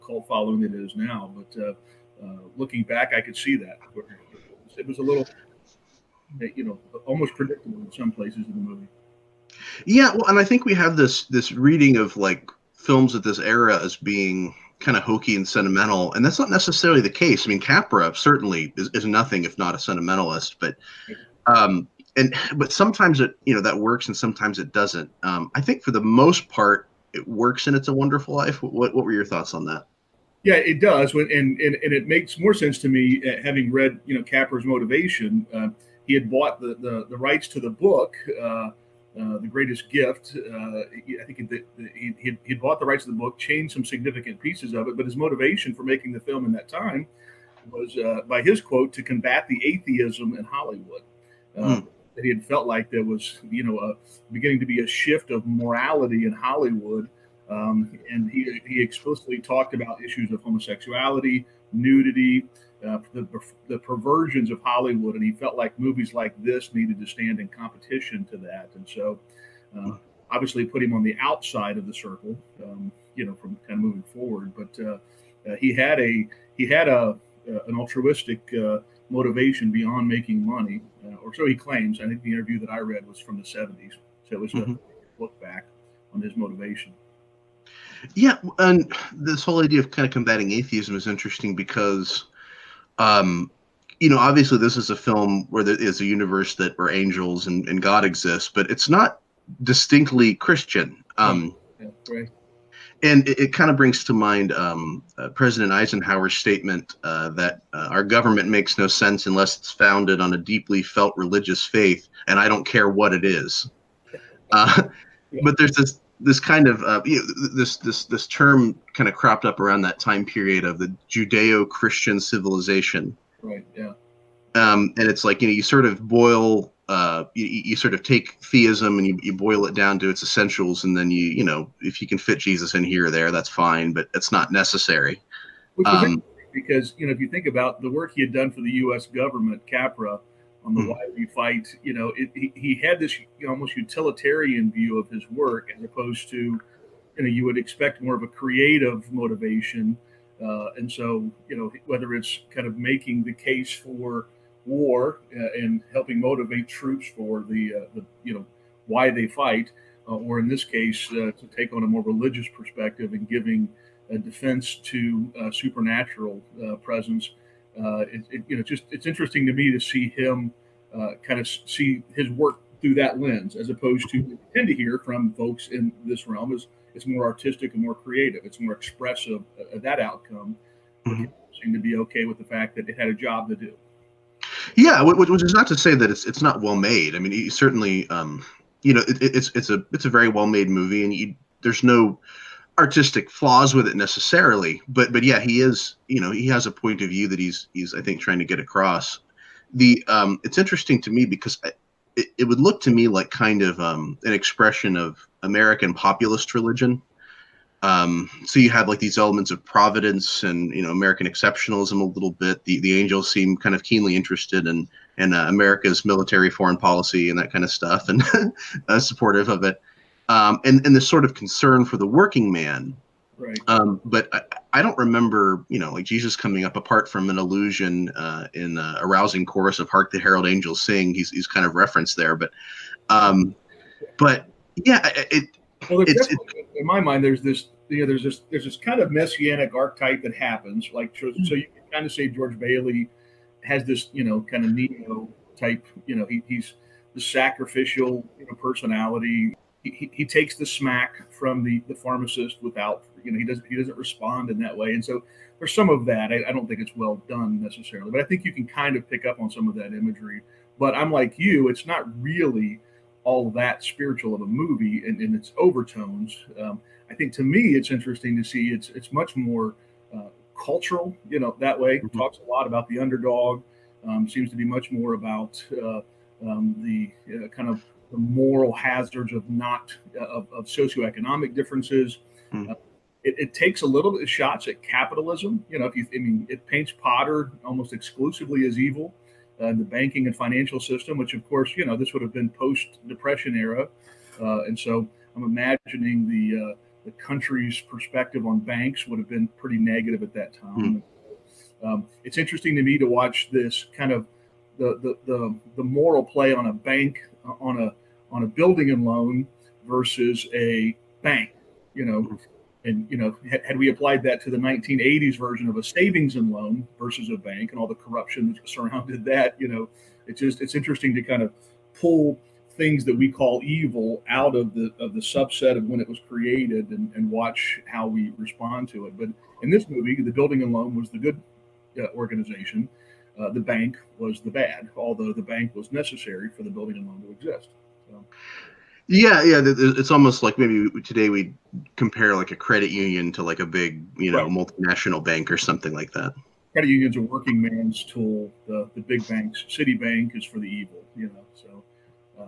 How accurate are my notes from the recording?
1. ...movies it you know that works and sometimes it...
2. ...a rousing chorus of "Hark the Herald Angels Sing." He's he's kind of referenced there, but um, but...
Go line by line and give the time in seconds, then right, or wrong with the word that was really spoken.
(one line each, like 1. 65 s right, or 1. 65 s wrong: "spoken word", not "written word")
1. 22 s wrong: "sometimes", not "movies"
2. 228 s right.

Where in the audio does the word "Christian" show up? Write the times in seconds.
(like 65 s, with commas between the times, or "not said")
100 s, 121 s.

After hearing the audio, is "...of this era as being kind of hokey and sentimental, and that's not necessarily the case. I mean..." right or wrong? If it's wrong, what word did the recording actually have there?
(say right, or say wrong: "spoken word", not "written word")
right.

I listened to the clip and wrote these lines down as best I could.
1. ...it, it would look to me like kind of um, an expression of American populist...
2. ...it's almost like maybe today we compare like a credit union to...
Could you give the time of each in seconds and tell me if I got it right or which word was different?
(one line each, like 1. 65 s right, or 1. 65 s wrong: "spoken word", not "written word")
1. 202 s right
2. 339 s right.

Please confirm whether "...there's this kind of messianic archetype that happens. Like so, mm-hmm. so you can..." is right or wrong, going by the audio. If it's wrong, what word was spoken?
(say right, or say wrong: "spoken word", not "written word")
right.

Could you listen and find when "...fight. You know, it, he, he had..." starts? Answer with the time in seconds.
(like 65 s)
141 s.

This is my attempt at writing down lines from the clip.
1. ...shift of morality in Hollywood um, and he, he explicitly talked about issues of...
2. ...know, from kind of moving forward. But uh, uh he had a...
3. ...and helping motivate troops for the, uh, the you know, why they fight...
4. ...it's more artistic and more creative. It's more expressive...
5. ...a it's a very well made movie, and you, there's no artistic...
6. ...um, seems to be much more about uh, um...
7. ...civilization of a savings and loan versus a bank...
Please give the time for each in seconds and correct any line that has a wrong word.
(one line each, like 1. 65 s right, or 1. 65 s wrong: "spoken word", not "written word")
1. 54 s right
2. 73 s right
3. 155 s right
4. 176 s right
5. 189 s right
6. 274 s right
7. 315 s wrong: "version", not "civilization".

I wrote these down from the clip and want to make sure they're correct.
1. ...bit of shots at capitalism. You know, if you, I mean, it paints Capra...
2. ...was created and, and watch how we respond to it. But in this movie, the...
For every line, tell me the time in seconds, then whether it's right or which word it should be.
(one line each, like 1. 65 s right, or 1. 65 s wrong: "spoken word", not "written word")
1. 284 s wrong: "Potter", not "Capra"
2. 326 s right.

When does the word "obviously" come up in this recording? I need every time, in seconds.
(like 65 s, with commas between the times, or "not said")
70 s, 94 s.